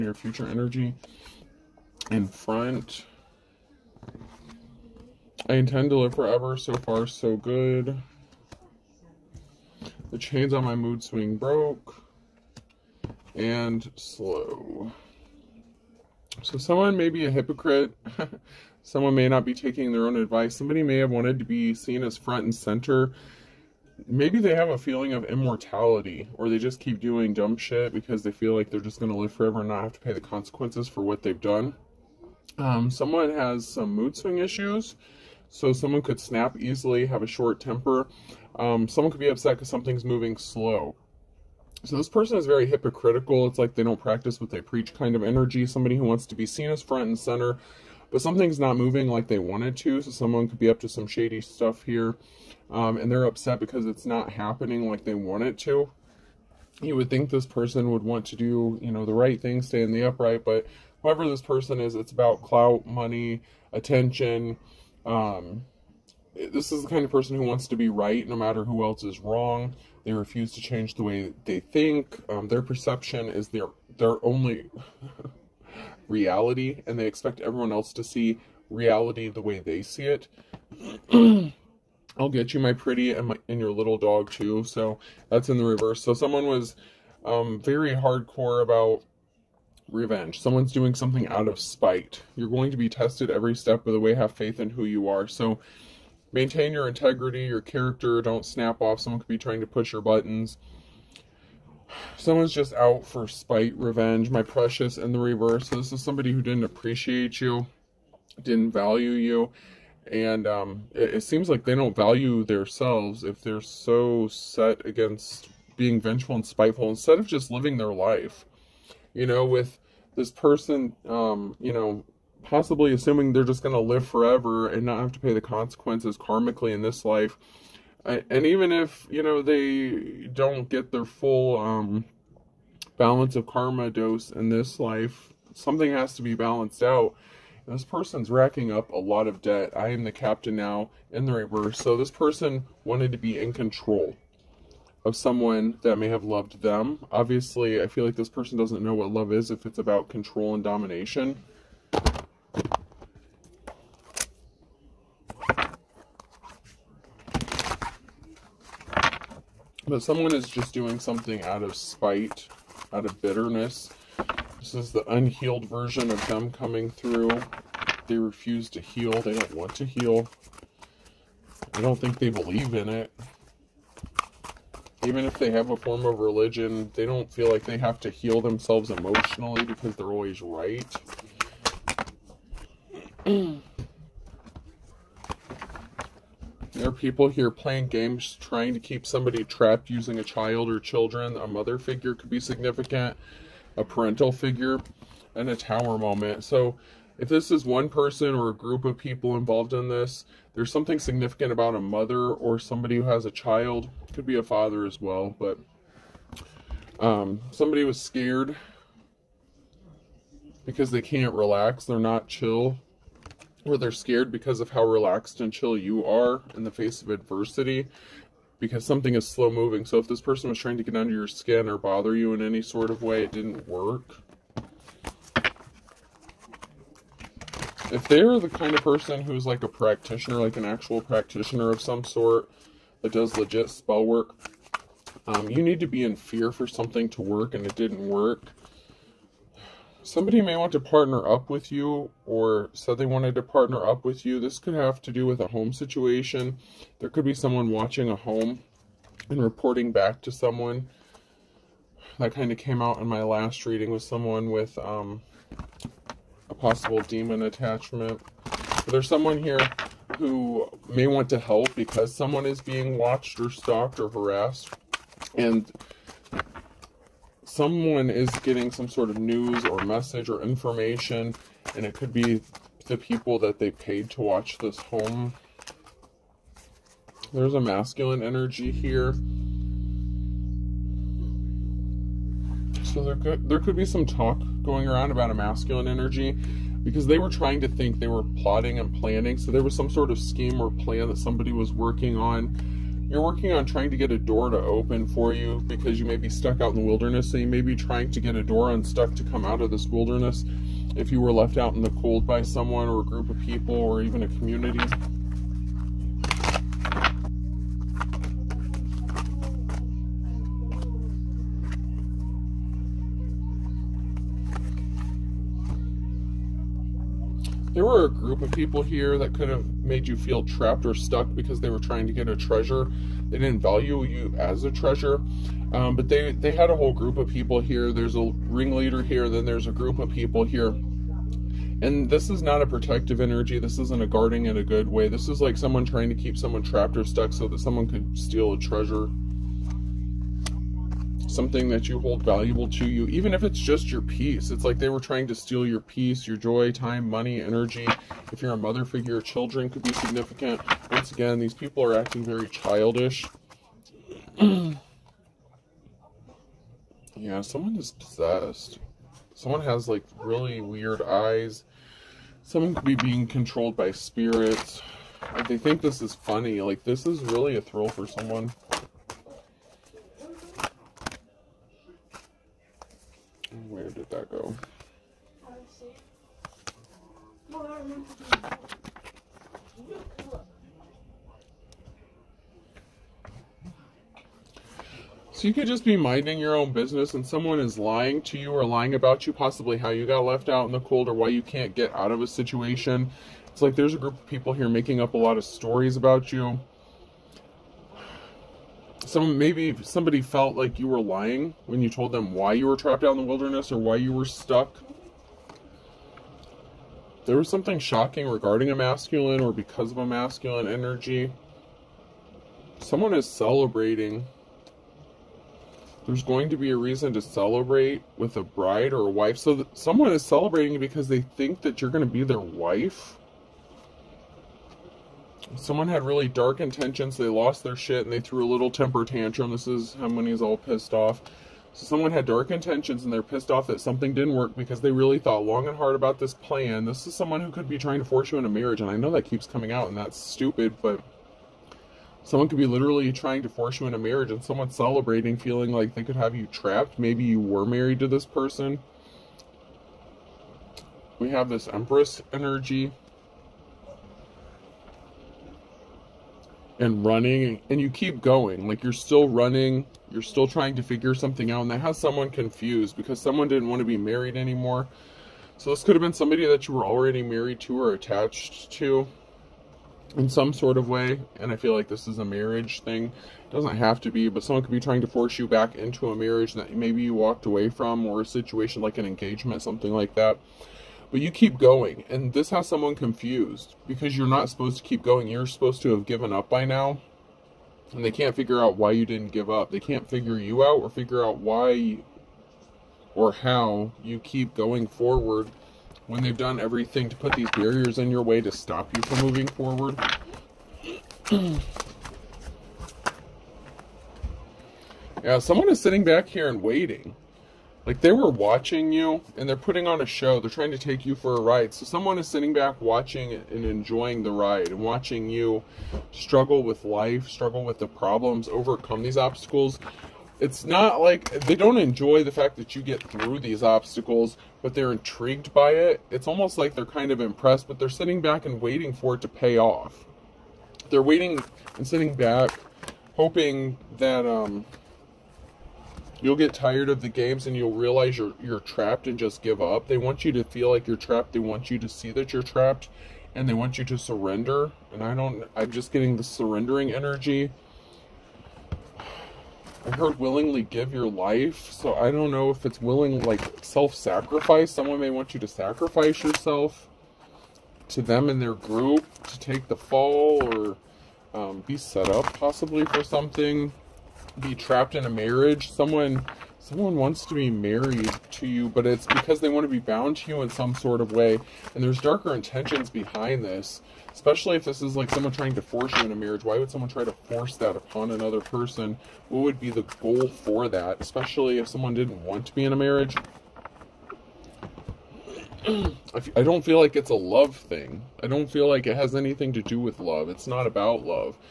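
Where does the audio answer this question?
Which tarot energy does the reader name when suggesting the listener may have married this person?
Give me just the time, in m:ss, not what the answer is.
7:31.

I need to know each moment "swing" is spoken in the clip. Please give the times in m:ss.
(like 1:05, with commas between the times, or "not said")
0:11, 0:34.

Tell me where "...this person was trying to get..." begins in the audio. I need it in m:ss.
3:40.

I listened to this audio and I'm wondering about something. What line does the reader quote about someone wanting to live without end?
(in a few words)
I intend to live forever.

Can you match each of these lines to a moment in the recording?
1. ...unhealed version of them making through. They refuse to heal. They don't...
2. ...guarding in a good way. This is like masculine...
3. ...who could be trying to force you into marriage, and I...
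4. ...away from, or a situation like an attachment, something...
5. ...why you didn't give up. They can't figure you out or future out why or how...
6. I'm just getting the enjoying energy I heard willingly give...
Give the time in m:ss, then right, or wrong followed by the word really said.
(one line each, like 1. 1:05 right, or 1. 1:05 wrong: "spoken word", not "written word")
1. 2:45 wrong: "coming", not "making"
2. 5:34 wrong: "someone", not "masculine"
3. 7:17 right
4. 7:57 wrong: "engagement", not "attachment"
5. 8:08 wrong: "figure", not "future"
6. 9:05 wrong: "surrendering", not "enjoying".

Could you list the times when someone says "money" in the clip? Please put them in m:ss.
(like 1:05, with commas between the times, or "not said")
1:02, 5:47.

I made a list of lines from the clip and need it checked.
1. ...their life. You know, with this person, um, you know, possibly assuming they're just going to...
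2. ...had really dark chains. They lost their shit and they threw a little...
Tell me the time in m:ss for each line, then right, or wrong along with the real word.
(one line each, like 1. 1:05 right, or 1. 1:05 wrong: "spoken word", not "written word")
1. 1:57 right
2. 7:05 wrong: "intentions", not "chains".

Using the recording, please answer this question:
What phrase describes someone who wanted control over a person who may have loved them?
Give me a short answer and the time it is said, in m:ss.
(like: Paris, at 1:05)
I am the captain now, at 2:19.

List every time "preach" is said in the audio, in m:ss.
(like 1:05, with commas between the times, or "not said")
0:44.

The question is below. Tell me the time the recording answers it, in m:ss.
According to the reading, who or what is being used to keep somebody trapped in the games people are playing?
3:10.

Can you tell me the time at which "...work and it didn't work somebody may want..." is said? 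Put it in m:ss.
3:57.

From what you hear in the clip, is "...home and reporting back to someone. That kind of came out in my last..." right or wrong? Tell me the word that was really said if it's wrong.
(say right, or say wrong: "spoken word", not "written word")
right.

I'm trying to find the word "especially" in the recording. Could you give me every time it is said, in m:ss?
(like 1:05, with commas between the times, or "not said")
9:34, 9:41.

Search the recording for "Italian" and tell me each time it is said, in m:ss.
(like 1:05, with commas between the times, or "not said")
not said.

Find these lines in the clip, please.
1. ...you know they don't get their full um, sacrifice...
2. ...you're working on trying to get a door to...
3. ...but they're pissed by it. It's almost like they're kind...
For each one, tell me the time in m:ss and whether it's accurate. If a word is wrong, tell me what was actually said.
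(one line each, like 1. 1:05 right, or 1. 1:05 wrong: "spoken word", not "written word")
1. 2:09 wrong: "balance", not "sacrifice"
2. 4:53 right
3. 8:44 wrong: "intrigued", not "pissed".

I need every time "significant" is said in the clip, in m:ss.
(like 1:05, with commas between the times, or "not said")
3:12, 3:21, 5:49.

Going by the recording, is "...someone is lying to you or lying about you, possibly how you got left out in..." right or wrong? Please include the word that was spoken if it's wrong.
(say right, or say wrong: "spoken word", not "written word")
right.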